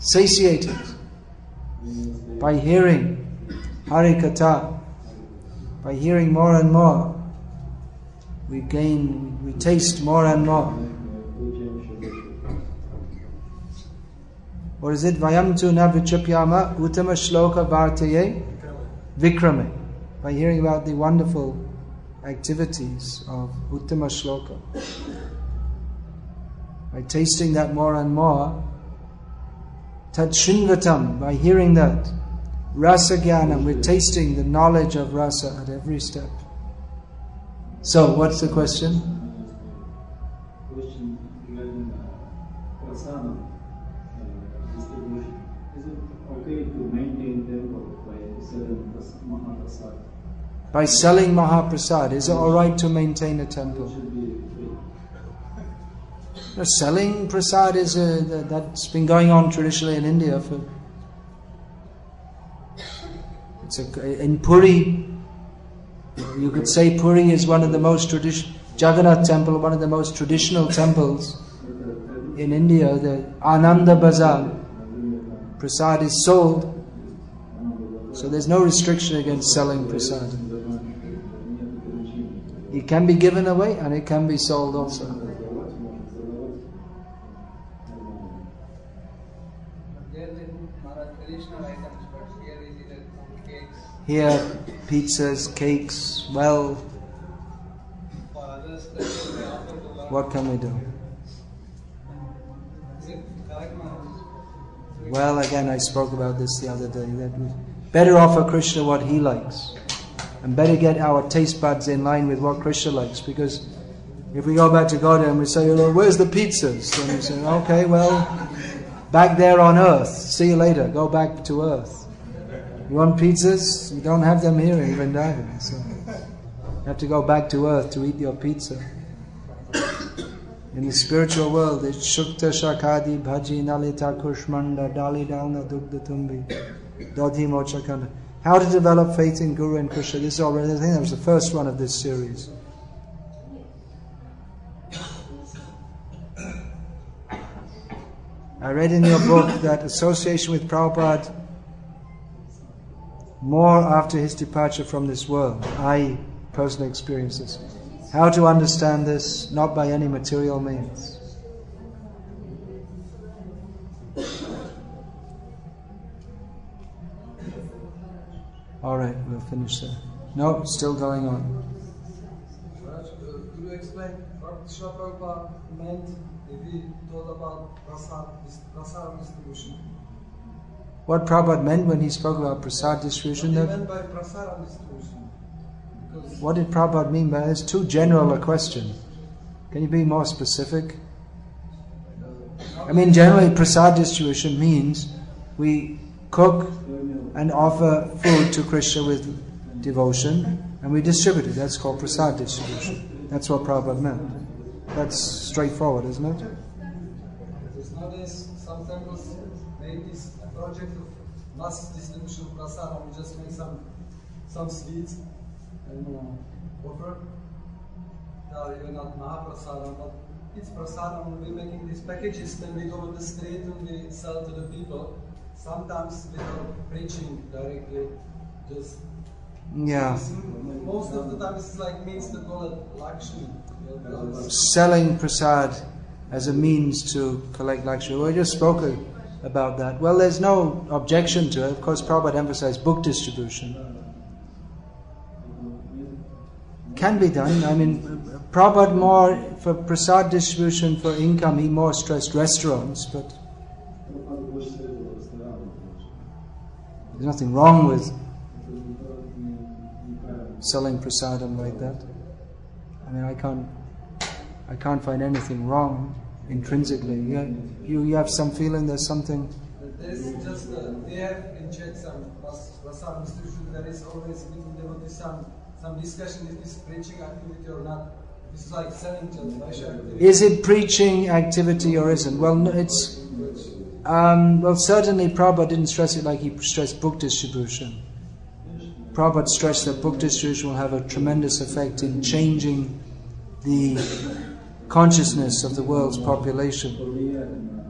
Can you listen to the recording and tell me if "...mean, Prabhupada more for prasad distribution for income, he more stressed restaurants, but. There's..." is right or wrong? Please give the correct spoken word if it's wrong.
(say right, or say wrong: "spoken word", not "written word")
right.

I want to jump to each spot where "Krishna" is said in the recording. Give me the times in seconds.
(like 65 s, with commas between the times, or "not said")
108 s, 112 s, 139 s, 174 s, 198 s.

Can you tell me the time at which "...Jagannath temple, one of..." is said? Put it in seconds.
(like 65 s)
68 s.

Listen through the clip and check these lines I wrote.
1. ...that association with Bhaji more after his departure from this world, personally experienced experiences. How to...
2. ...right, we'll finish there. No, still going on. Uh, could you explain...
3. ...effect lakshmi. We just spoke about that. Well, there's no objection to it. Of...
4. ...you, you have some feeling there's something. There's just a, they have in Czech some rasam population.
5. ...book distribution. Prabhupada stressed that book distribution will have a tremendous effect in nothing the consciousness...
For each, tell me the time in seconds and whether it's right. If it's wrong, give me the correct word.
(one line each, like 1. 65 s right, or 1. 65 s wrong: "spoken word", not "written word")
1. 149 s wrong: "Prabhupada", not "Bhaji"
2. 168 s right
3. 237 s wrong: "collect", not "effect"
4. 267 s wrong: "distribution", not "population"
5. 286 s wrong: "changing", not "nothing".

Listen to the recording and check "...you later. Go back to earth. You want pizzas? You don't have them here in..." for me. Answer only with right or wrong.
right.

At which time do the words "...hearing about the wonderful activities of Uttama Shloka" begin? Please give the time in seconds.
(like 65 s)
20 s.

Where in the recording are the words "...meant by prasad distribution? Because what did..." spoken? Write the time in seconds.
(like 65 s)
183 s.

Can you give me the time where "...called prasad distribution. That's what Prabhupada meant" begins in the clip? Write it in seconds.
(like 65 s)
201 s.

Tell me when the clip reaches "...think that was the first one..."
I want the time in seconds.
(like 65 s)
140 s.